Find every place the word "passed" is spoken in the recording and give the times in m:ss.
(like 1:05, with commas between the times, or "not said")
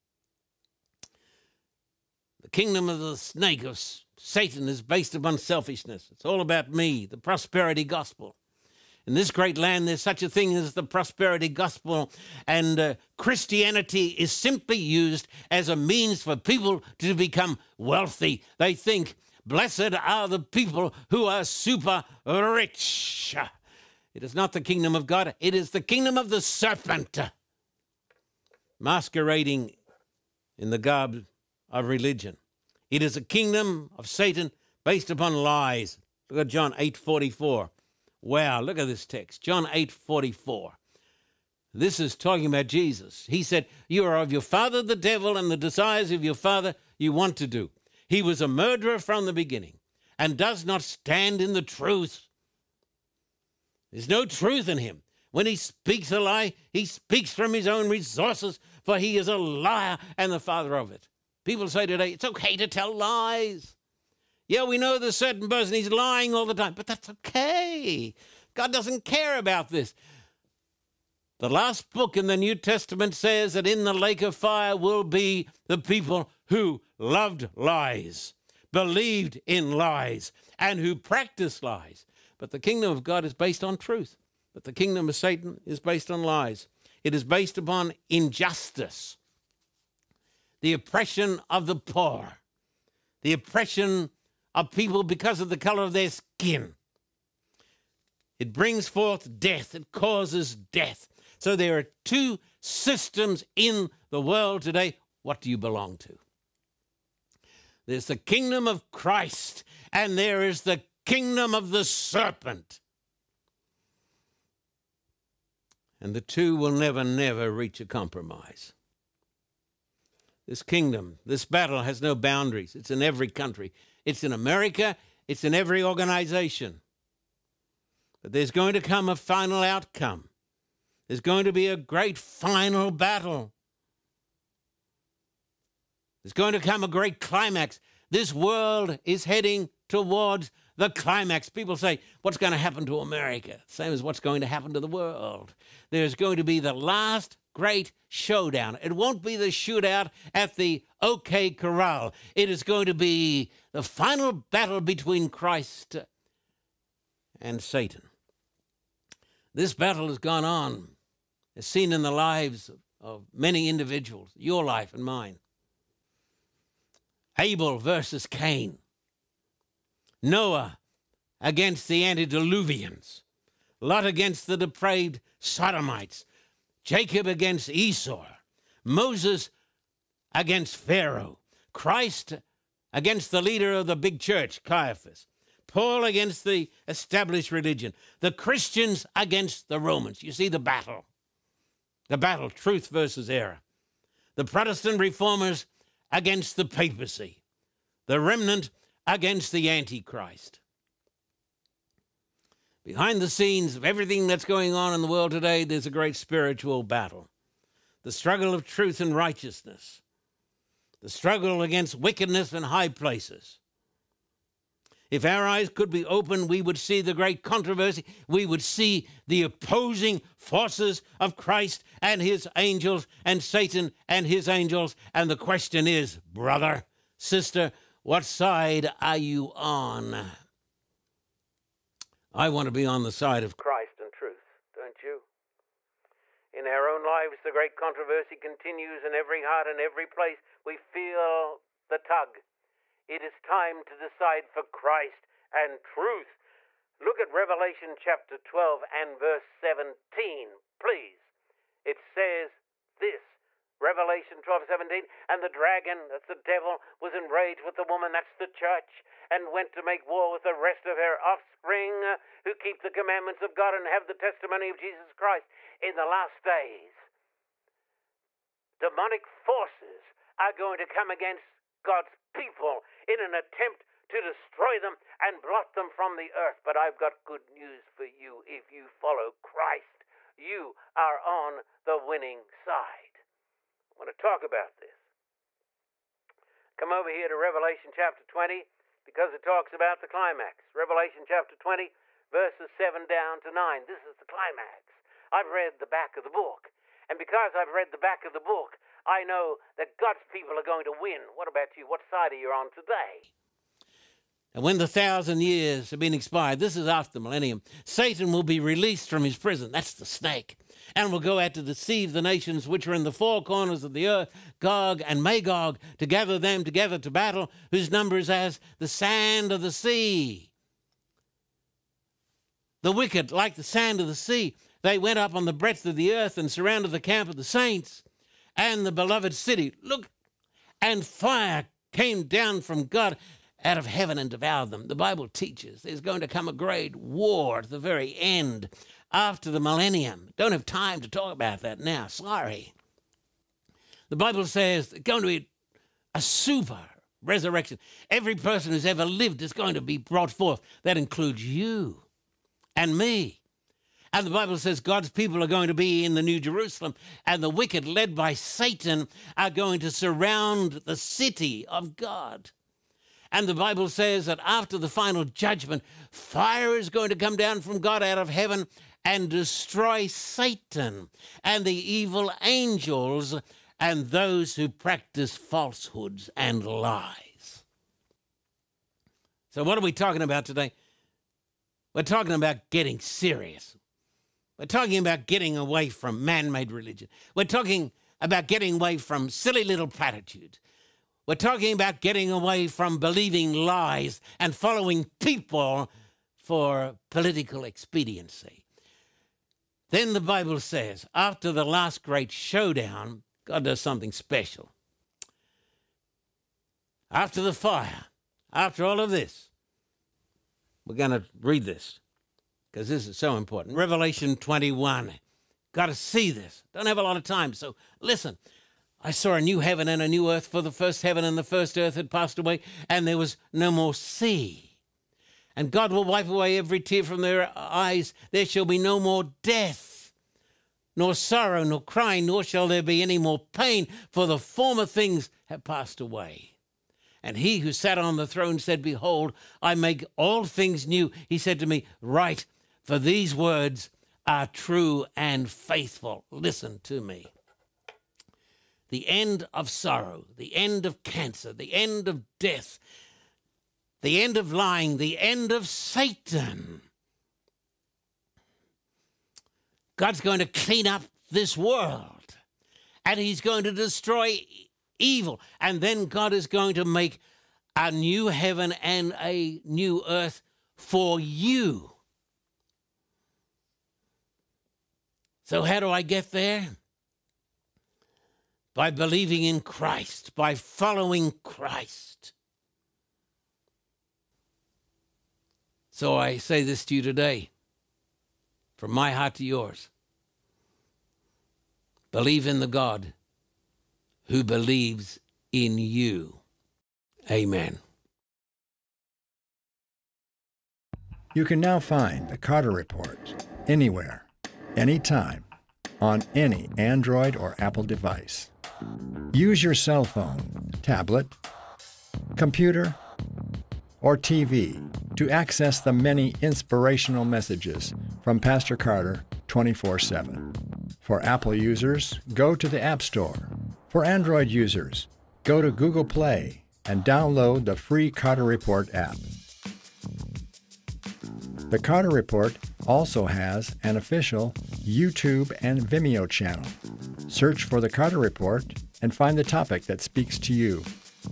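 7:02, 7:15.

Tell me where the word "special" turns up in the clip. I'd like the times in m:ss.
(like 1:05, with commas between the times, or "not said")
6:44.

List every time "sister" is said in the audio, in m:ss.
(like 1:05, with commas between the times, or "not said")
3:47.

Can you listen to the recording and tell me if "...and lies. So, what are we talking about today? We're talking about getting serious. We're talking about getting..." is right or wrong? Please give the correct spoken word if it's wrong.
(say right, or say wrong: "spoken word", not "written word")
right.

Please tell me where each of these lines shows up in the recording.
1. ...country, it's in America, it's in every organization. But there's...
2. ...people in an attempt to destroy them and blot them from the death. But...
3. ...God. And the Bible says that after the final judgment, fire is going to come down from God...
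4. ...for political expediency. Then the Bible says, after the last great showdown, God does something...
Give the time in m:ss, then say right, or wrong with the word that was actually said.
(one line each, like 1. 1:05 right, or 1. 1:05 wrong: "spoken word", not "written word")
1. 2:03 right
2. 4:32 wrong: "earth", not "death"
3. 6:01 right
4. 6:36 right.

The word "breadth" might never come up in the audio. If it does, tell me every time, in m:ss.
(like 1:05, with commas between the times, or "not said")
5:25.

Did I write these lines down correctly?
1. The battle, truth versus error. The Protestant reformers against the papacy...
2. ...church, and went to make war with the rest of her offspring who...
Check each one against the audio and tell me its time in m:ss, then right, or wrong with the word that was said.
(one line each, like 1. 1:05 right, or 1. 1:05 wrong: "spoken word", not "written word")
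1. 3:12 right
2. 4:18 right.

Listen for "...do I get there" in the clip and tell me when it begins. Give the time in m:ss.
7:55.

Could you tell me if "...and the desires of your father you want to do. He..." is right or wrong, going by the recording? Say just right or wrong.
right.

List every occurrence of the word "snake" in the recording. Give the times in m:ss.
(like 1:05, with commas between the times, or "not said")
0:03, 5:10.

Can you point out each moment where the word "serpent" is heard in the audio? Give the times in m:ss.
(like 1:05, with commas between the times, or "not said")
0:26, 1:51.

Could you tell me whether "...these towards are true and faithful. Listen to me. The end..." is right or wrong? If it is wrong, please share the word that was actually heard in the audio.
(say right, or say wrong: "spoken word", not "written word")
wrong: "words", not "towards".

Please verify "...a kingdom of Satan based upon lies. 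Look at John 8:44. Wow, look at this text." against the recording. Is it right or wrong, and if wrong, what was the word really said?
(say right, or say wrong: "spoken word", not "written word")
right.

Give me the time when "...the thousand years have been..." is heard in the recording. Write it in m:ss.
5:04.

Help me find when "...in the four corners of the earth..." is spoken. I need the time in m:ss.
5:12.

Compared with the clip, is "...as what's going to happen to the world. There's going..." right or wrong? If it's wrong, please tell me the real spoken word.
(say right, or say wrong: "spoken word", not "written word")
right.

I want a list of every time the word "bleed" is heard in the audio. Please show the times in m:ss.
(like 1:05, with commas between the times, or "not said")
not said.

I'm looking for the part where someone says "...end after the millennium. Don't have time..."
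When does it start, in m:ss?
5:38.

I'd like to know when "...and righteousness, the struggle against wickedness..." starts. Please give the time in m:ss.
3:29.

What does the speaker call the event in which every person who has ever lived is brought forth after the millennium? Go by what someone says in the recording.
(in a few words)
super resurrection.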